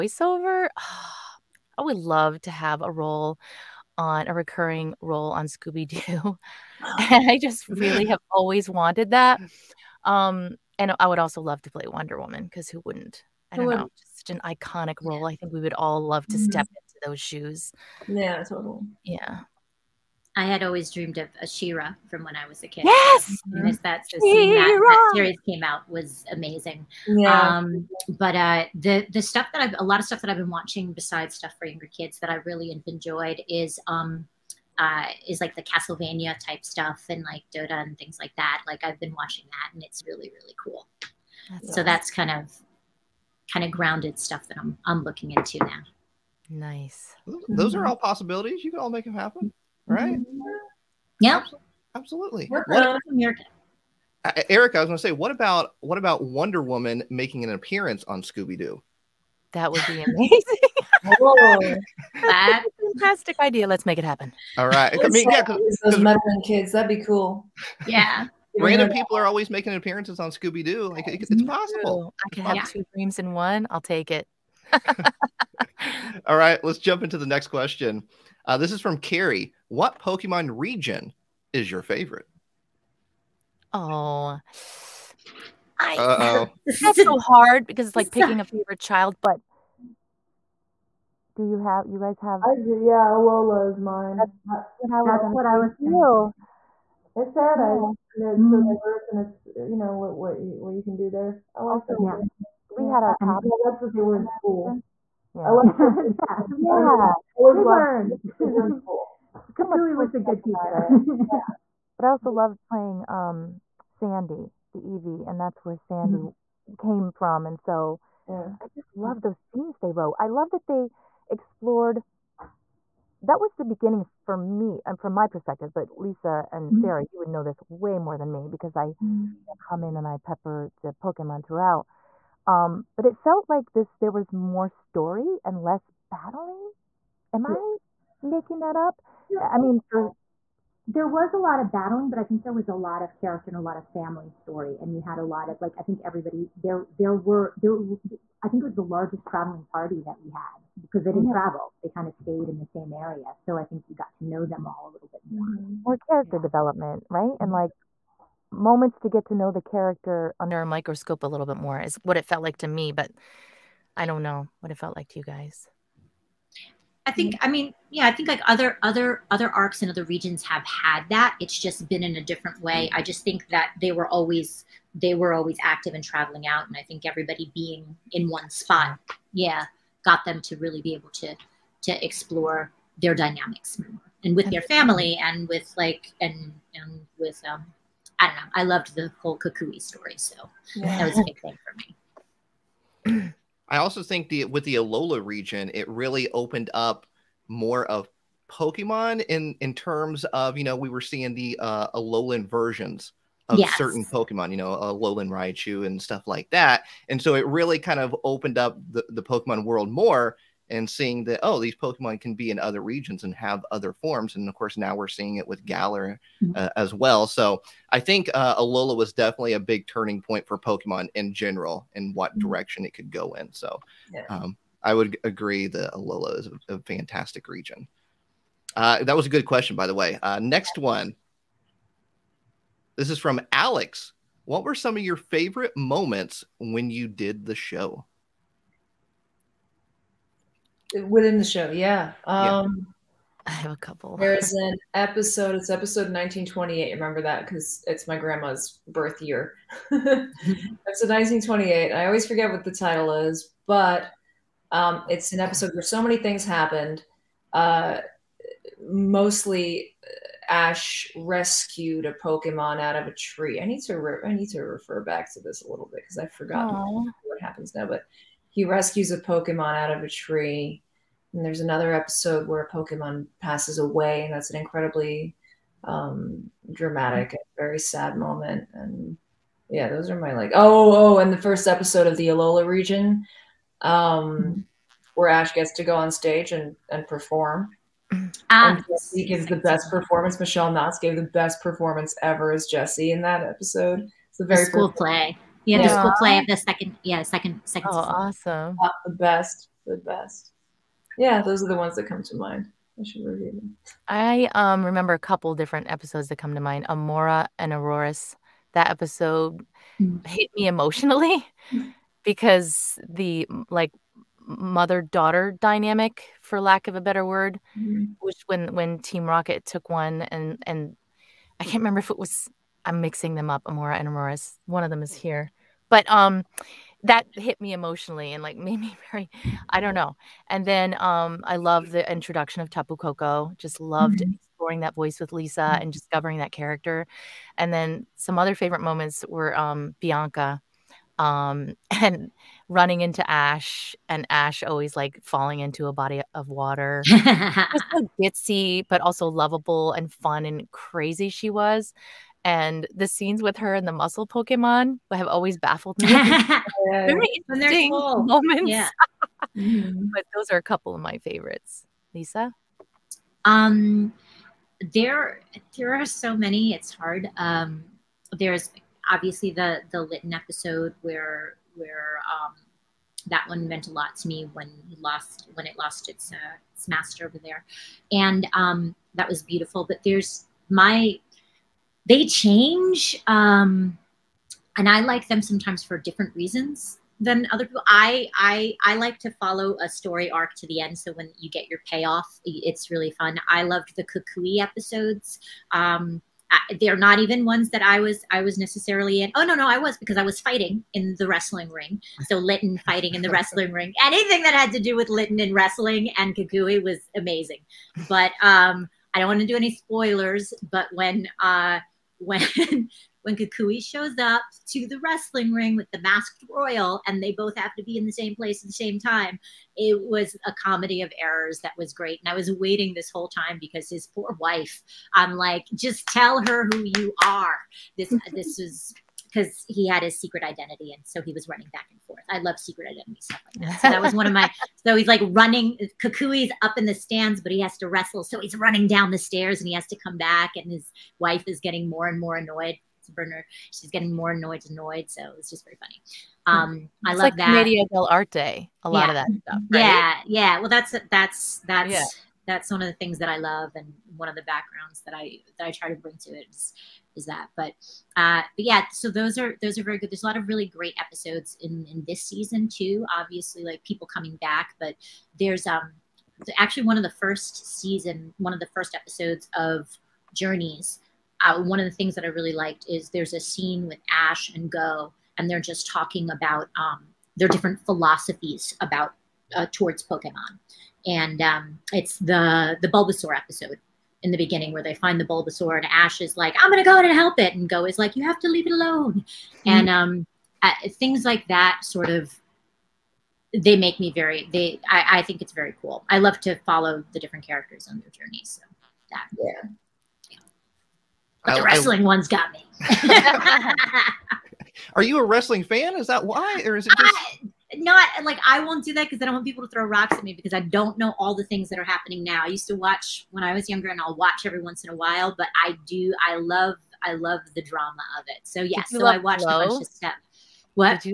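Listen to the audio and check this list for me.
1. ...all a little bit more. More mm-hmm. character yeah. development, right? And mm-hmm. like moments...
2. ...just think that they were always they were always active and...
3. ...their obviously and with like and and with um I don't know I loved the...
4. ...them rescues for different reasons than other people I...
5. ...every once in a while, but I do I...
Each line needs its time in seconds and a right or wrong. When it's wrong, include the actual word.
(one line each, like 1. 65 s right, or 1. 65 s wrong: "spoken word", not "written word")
1. 154 s right
2. 173 s right
3. 184 s wrong: "family", not "obviously"
4. 385 s wrong: "sometimes", not "rescues"
5. 514 s right.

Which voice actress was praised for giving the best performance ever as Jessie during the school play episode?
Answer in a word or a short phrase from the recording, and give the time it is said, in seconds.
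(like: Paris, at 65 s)
Michele Knotz, at 290 s.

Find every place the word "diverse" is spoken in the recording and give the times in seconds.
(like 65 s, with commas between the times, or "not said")
98 s.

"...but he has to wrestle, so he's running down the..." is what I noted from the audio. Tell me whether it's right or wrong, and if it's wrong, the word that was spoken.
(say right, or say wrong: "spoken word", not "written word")
right.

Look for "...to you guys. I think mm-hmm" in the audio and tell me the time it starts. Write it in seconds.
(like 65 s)
165 s.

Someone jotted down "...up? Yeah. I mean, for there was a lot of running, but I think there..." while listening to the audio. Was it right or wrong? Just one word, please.
wrong.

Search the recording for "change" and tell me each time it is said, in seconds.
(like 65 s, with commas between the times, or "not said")
382 s.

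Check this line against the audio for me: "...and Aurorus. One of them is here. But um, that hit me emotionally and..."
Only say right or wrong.
right.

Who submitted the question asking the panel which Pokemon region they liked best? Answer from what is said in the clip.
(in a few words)
Carrie.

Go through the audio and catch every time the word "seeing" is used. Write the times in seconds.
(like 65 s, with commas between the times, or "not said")
200 s, 210 s, 215 s.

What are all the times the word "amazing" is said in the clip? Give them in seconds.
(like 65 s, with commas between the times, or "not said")
26 s, 60 s, 407 s.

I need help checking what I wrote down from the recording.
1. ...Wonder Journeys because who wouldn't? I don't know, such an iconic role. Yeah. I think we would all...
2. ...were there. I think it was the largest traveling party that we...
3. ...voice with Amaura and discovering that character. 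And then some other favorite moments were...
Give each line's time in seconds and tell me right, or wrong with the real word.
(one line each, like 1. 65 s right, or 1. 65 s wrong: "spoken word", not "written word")
1. 11 s wrong: "Woman", not "Journeys"
2. 147 s right
3. 334 s wrong: "Lisa", not "Amaura".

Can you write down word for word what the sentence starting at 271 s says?
And there's another episode where a Pokemon passes away, and that's an incredibly um, dramatic and very sad moment.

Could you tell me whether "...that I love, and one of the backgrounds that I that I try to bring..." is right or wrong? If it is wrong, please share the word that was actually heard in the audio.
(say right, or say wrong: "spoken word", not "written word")
right.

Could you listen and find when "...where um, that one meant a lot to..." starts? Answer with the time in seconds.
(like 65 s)
371 s.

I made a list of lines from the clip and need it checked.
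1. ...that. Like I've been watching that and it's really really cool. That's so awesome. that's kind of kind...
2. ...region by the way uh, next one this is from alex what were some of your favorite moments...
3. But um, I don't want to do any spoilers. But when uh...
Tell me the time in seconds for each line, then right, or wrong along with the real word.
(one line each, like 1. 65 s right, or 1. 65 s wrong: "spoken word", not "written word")
1. 38 s right
2. 229 s wrong: "question", not "region"
3. 408 s right.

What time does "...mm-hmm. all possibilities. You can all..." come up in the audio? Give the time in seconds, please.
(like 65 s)
47 s.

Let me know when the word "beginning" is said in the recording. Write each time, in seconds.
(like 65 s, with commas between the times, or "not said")
123 s, 484 s.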